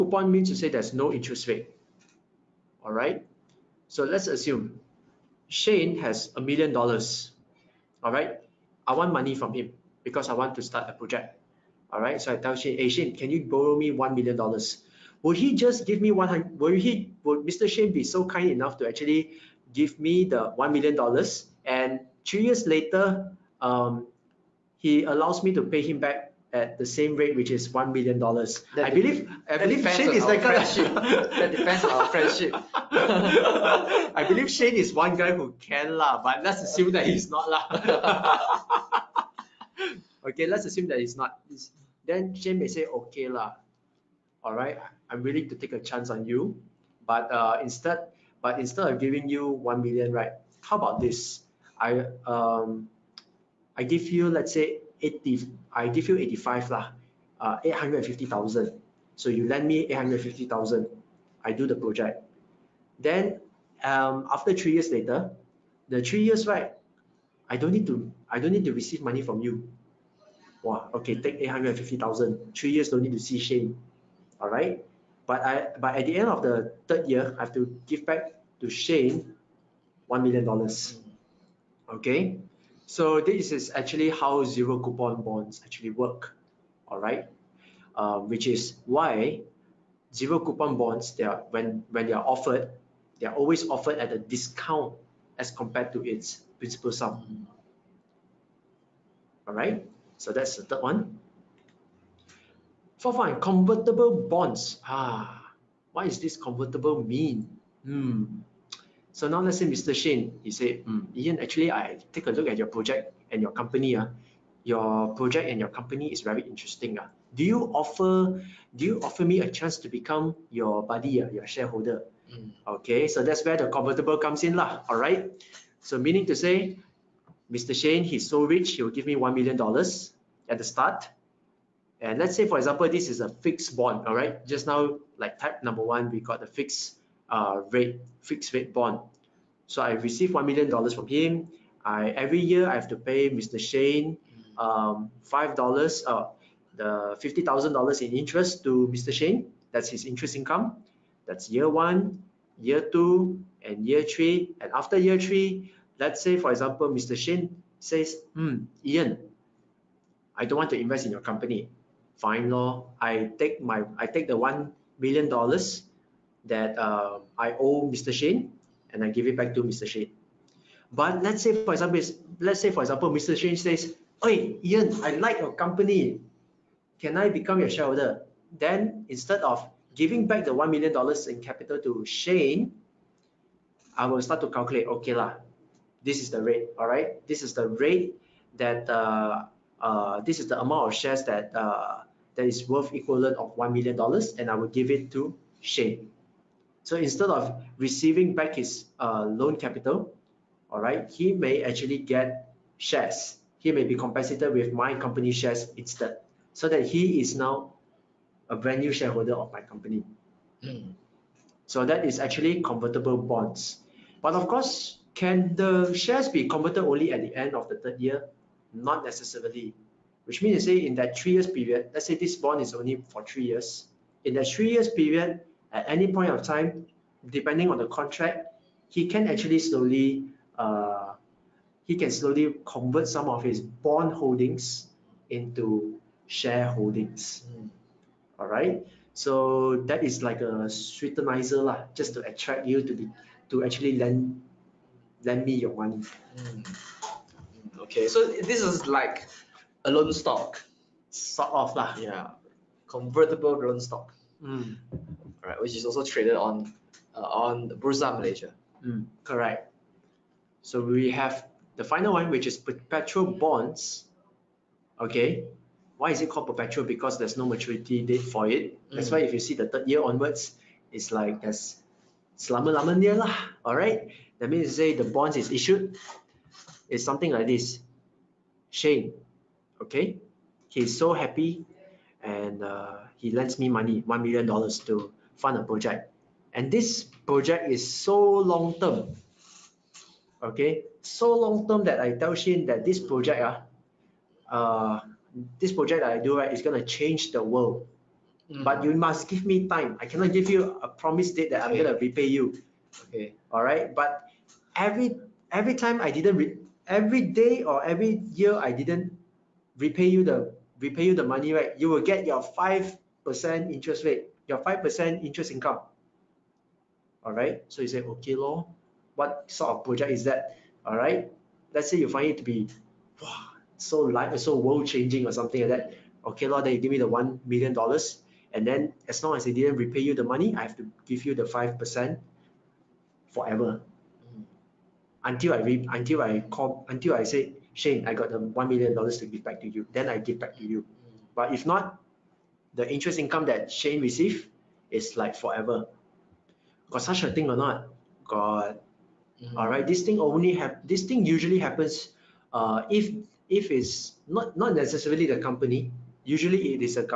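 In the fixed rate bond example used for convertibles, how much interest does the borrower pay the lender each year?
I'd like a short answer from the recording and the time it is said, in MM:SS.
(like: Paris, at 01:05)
50,000 dollars, at 02:27.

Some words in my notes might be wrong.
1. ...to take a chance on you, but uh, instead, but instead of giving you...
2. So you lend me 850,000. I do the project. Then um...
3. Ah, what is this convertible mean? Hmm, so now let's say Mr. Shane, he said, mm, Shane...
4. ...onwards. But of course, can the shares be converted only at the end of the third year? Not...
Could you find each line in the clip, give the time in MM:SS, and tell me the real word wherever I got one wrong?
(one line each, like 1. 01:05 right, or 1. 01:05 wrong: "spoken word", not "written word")
1. 00:45 right
2. 00:59 right
3. 01:44 wrong: "Ian", not "Shane"
4. 03:33 wrong: "bonds", not "onwards".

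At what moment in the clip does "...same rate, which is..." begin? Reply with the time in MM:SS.
00:26.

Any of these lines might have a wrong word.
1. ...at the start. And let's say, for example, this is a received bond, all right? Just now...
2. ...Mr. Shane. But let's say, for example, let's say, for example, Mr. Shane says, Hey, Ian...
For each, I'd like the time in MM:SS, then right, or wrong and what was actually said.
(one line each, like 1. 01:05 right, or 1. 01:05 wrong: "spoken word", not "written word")
1. 02:10 wrong: "fixed", not "received"
2. 02:49 right.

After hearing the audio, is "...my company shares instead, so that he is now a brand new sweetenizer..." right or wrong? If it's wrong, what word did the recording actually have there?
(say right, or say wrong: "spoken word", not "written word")
wrong: "shareholder", not "sweetenizer".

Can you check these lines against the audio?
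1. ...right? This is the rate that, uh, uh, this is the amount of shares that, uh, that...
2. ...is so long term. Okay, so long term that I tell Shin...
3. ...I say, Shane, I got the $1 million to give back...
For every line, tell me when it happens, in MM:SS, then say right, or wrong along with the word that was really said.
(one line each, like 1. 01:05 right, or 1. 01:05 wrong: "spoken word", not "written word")
1. 03:06 right
2. 04:47 right
3. 05:37 right.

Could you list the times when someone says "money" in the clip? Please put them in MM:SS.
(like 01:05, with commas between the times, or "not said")
00:09, 01:09, 04:05, 04:43, 05:11, 05:30.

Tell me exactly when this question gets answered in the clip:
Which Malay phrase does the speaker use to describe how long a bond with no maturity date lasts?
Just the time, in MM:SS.
04:32.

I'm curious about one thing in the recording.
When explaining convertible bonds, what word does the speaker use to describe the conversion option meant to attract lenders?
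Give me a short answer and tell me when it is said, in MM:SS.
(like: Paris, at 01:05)
sweetenizer, at 04:00.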